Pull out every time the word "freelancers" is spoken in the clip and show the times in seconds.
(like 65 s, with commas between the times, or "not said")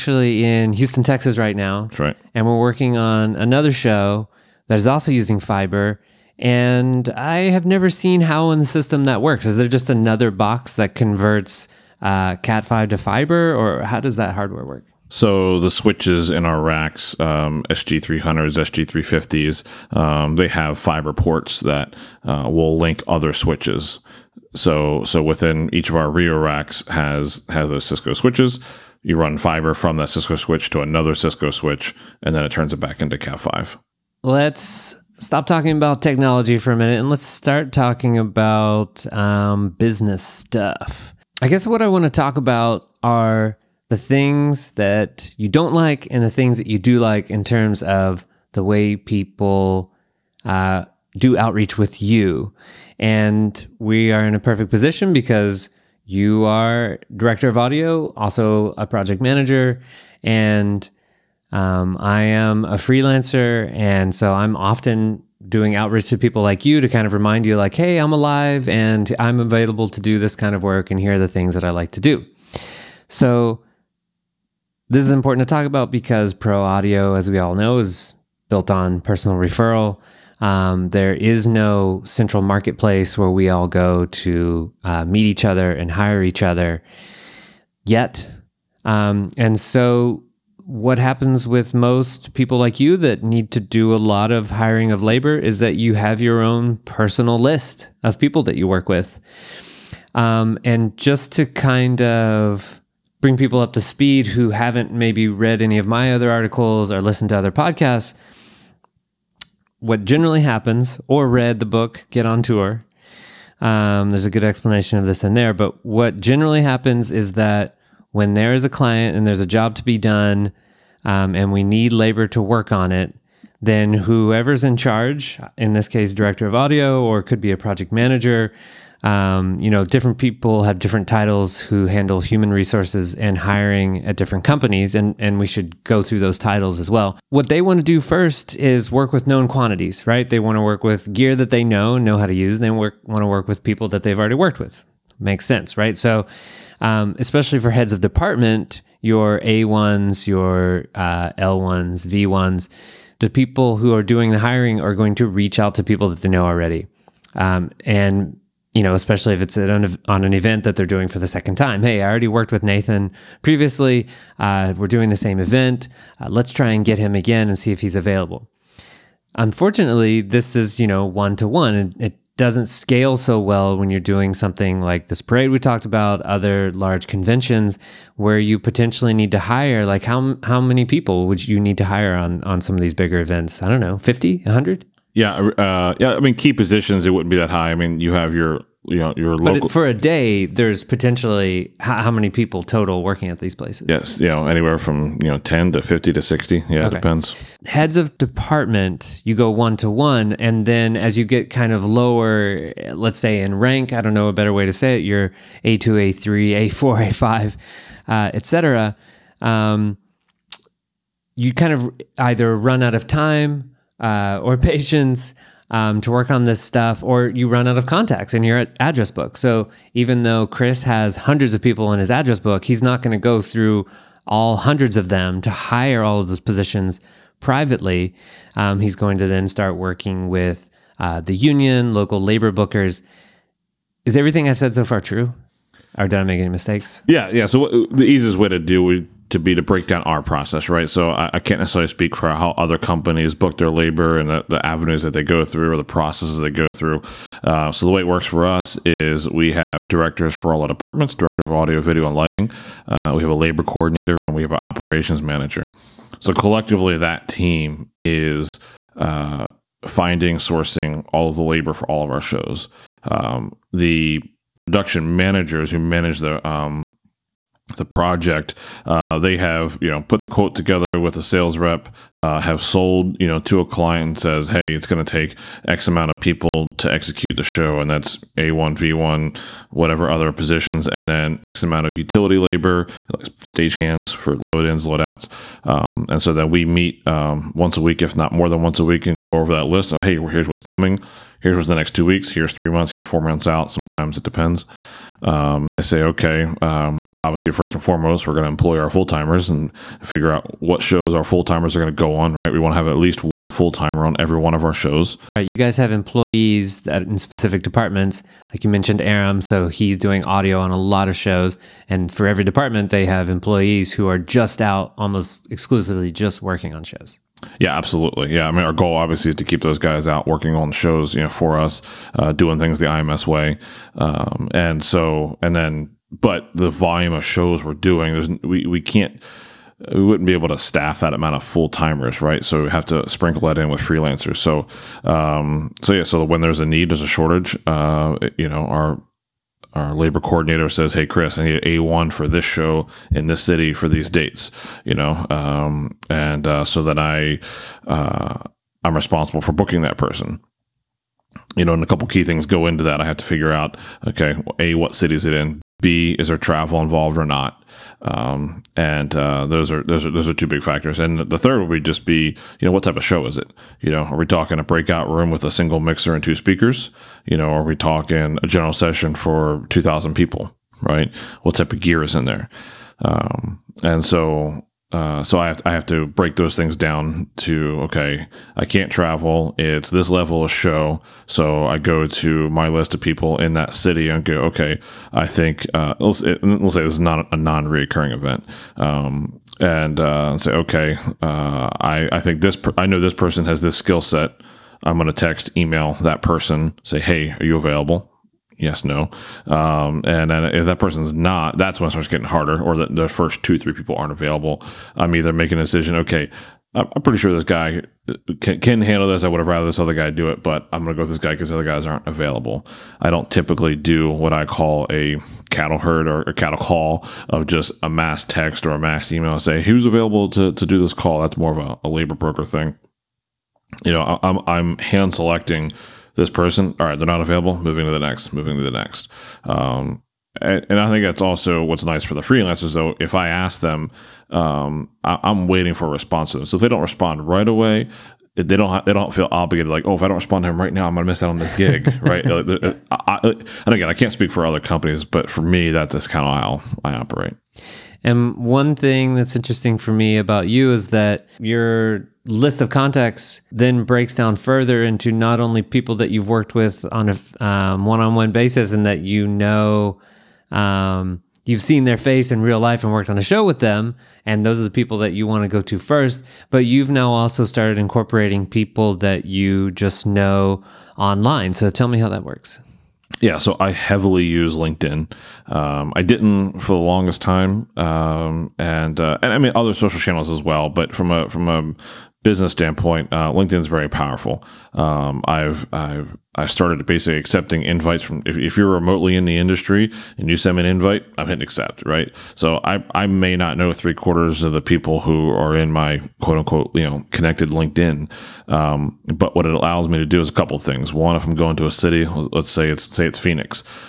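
62 s, 333 s, 432 s.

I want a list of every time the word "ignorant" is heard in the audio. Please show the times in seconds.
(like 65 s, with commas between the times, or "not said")
not said.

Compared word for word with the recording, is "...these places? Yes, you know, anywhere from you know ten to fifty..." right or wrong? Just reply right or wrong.
right.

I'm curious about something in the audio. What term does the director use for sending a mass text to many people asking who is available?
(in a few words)
cattle call.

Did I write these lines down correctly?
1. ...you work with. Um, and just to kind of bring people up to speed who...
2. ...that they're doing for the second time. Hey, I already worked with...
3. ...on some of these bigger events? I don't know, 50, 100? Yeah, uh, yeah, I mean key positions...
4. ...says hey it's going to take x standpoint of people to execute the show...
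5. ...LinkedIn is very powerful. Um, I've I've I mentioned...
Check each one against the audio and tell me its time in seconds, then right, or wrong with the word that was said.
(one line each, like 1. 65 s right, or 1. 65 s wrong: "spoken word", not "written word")
1. 98 s right
2. 160 s right
3. 182 s right
4. 274 s wrong: "amount", not "standpoint"
5. 483 s wrong: "started", not "mentioned".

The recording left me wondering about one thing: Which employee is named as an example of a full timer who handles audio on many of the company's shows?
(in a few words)
Aram.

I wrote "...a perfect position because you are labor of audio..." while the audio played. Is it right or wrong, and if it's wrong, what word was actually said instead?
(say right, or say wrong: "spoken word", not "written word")
wrong: "director", not "labor".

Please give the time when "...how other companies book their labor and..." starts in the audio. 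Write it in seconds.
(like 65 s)
242 s.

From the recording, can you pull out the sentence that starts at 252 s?
Uh, we have a labor coordinator and we have an operations manager.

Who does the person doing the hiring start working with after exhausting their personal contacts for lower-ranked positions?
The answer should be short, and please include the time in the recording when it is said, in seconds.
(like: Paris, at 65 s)
the union, local labor bookers, at 231 s.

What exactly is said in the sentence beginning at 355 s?
B, is there travel involved or not?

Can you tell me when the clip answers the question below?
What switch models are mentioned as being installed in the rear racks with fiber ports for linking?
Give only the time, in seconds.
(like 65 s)
17 s.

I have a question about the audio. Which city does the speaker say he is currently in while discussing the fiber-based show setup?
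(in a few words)
Houston, Texas.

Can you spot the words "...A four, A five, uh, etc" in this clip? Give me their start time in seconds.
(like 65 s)
206 s.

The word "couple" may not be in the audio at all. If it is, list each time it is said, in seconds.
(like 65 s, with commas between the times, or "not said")
351 s, 500 s.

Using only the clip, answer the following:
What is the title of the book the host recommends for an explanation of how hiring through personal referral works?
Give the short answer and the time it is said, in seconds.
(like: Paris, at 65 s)
Get on Tour, at 112 s.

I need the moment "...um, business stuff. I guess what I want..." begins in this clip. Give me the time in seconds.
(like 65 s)
39 s.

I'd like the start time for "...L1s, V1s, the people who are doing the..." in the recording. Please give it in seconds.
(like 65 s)
151 s.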